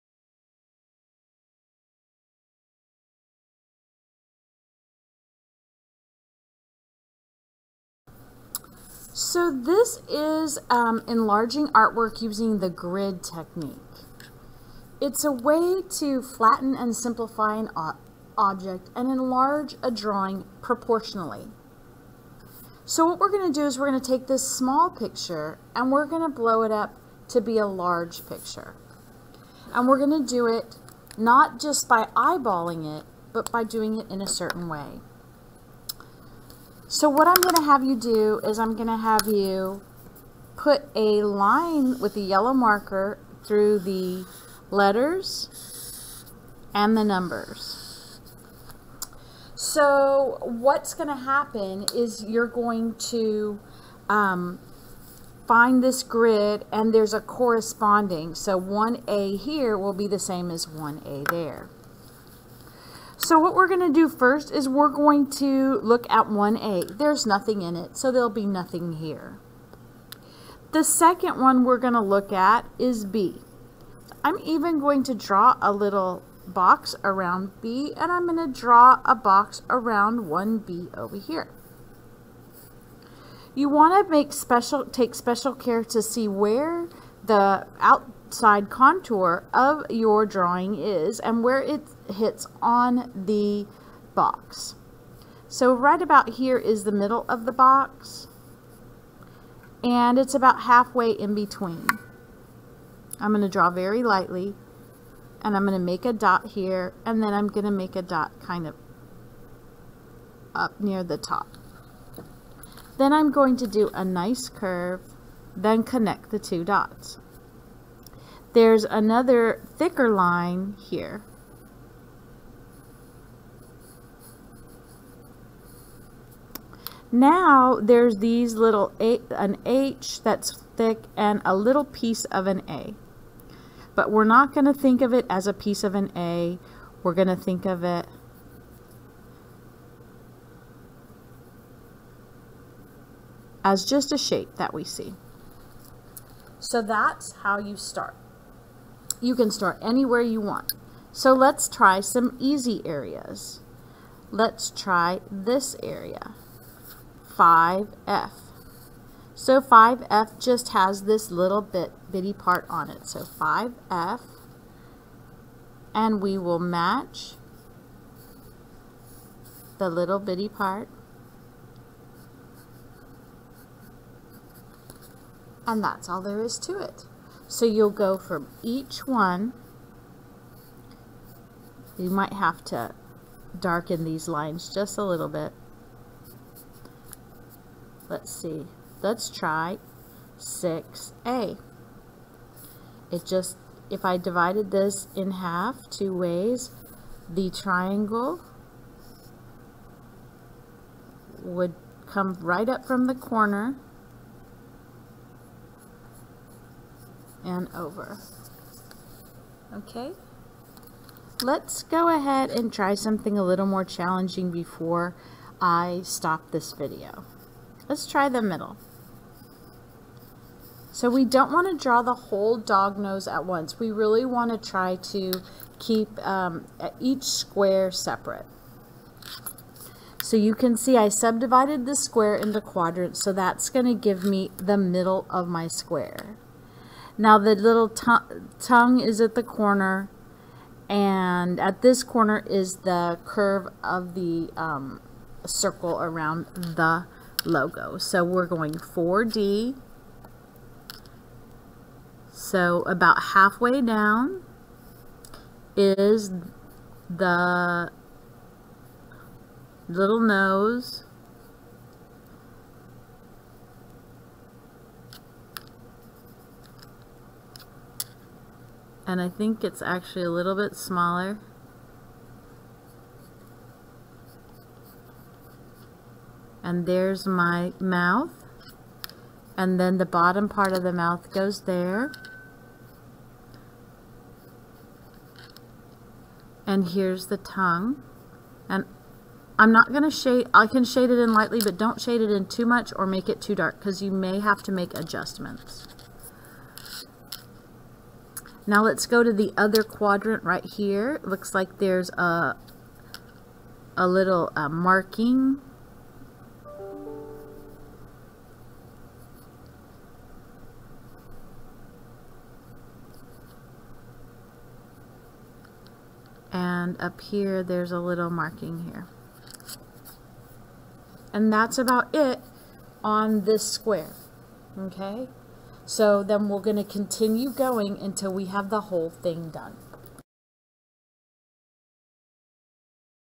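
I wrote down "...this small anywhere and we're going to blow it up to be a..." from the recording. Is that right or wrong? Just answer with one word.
wrong.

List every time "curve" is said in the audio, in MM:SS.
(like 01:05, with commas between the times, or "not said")
01:54, 04:03.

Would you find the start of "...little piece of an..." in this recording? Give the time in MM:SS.
02:11.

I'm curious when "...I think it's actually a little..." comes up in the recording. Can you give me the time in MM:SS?
04:29.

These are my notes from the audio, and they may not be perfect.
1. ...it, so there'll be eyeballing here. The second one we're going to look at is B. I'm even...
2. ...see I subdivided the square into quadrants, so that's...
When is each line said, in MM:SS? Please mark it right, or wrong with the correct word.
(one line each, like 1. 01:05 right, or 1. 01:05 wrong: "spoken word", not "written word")
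1. 01:07 wrong: "nothing", not "eyeballing"
2. 03:50 right.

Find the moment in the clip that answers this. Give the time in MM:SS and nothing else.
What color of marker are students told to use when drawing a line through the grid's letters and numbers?
00:42.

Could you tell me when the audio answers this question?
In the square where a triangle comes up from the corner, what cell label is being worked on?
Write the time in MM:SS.
03:10.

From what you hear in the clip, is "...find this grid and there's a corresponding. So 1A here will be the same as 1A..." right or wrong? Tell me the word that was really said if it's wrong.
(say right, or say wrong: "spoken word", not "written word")
right.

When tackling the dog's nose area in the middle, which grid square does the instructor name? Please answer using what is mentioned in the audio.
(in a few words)
4D.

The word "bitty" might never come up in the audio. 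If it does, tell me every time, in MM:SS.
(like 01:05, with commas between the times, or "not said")
02:42, 02:50.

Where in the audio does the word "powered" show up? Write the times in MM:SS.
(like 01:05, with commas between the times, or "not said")
not said.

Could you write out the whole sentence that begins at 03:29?
Okay, let's go ahead and try something a little more challenging before I stop this video.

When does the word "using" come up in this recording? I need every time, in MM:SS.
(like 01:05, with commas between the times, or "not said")
00:12.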